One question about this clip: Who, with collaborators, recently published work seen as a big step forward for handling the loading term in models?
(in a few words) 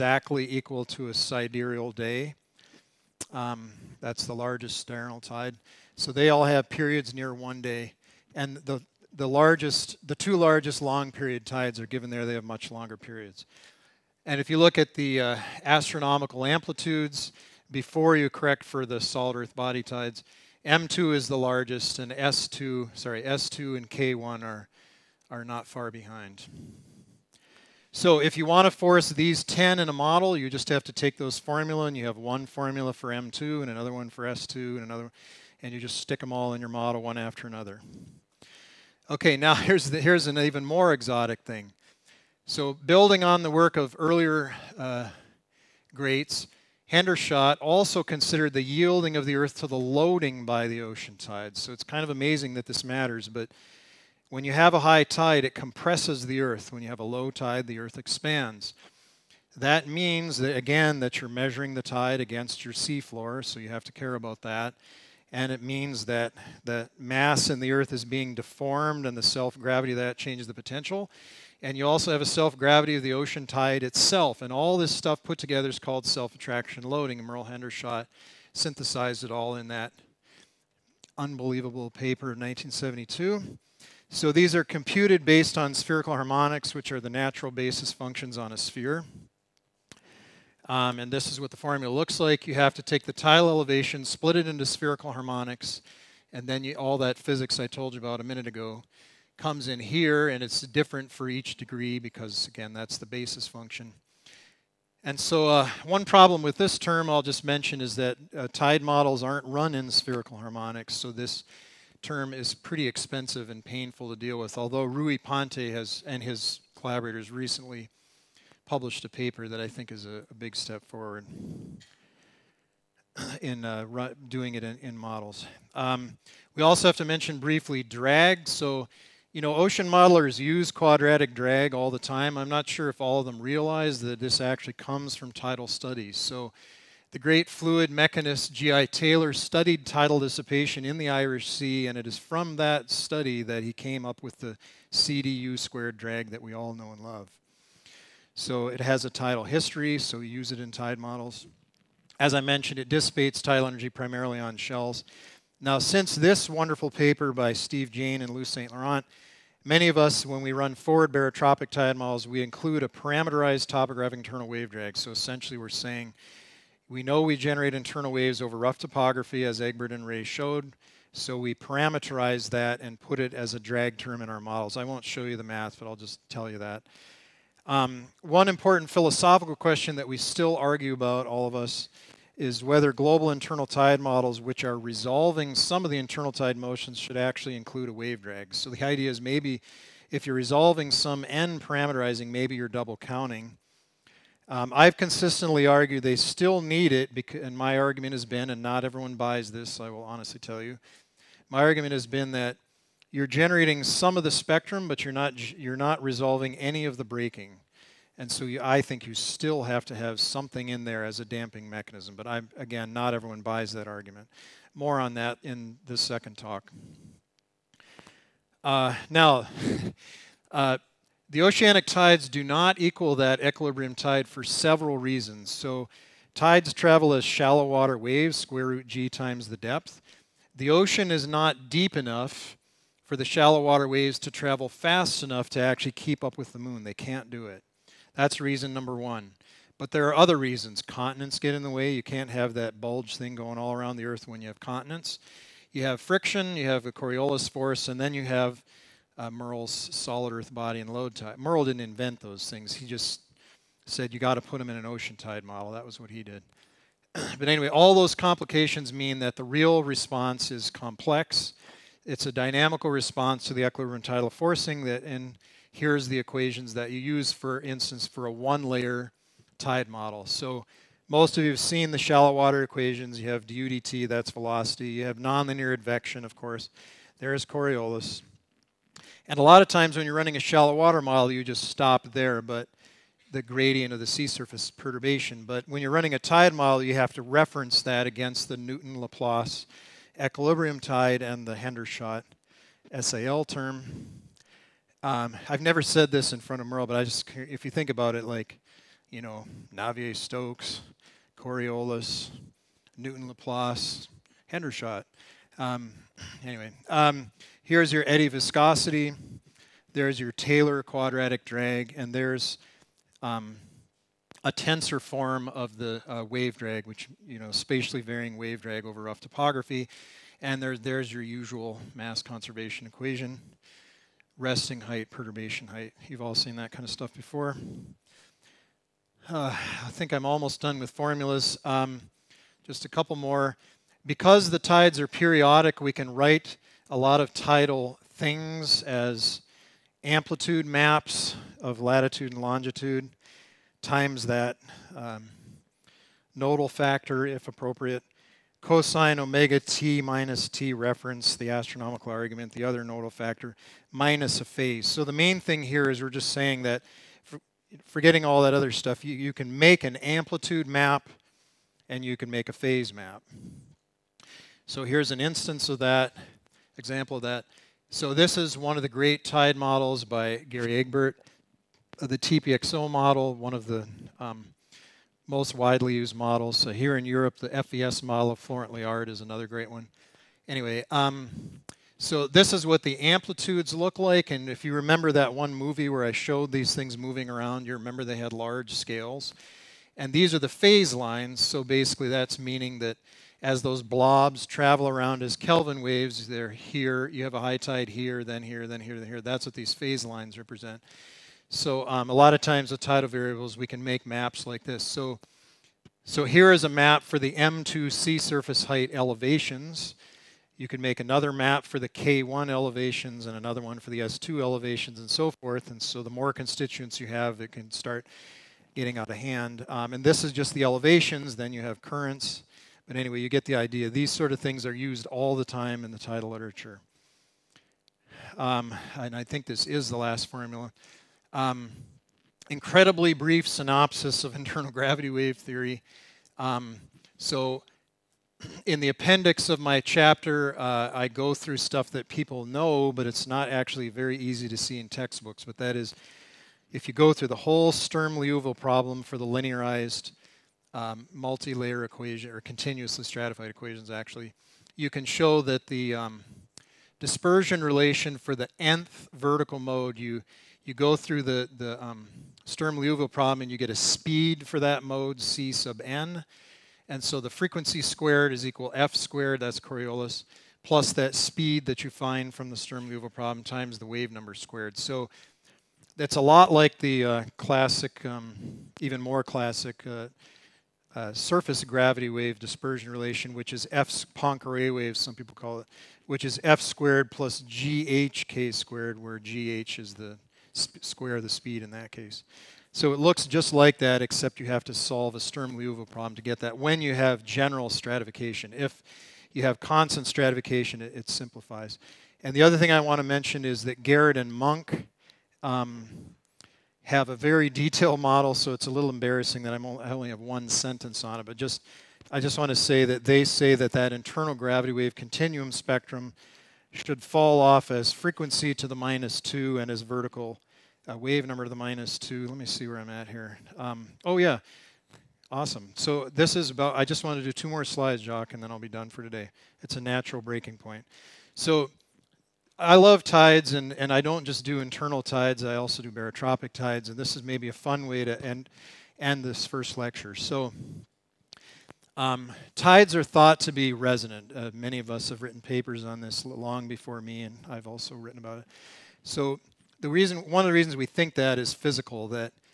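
Rui Ponte.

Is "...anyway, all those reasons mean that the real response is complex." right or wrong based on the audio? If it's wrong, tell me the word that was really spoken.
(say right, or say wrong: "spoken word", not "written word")
wrong: "complications", not "reasons".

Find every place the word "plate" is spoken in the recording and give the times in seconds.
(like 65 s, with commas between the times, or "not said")
not said.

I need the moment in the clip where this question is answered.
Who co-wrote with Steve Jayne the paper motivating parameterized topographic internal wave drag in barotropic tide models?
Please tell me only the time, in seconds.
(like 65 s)
158 s.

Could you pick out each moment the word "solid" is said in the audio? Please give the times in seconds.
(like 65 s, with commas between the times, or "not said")
18 s, 249 s.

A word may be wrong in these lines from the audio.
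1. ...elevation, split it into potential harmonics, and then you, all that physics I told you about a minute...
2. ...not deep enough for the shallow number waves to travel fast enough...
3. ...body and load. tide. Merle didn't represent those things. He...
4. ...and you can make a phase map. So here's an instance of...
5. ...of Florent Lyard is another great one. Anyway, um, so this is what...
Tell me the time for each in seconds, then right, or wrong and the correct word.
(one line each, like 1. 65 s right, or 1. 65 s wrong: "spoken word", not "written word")
1. 93 s wrong: "spherical", not "potential"
2. 231 s wrong: "water", not "number"
3. 250 s wrong: "invent", not "represent"
4. 361 s right
5. 378 s right.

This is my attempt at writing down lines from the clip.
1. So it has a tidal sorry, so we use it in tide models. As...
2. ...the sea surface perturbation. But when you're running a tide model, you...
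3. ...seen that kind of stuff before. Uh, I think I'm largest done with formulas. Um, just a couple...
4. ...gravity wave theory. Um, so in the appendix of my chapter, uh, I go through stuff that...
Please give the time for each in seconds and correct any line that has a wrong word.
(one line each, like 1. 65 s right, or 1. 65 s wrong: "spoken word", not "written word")
1. 148 s wrong: "history", not "sorry"
2. 283 s right
3. 326 s wrong: "almost", not "largest"
4. 434 s right.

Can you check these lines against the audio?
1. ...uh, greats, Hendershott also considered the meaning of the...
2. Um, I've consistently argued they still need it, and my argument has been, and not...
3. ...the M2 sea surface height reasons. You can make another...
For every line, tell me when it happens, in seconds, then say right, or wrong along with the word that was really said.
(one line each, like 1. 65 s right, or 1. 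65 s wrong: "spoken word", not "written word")
1. 44 s wrong: "yielding", not "meaning"
2. 194 s right
3. 407 s wrong: "elevations", not "reasons".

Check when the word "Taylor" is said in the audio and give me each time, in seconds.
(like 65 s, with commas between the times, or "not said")
138 s, 310 s.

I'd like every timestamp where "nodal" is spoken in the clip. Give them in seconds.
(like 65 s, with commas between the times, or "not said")
346 s, 352 s.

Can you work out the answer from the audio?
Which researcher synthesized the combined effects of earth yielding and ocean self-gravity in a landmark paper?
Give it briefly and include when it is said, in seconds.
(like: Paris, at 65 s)
Merle Hendershott, at 77 s.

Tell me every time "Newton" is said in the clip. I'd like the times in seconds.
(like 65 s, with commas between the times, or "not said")
288 s, 302 s.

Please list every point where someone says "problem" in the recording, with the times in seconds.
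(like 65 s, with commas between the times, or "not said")
106 s, 448 s, 463 s, 473 s, 495 s.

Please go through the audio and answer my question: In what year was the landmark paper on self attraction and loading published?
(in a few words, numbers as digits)
1972.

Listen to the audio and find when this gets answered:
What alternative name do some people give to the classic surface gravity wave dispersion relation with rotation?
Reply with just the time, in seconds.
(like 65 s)
484 s.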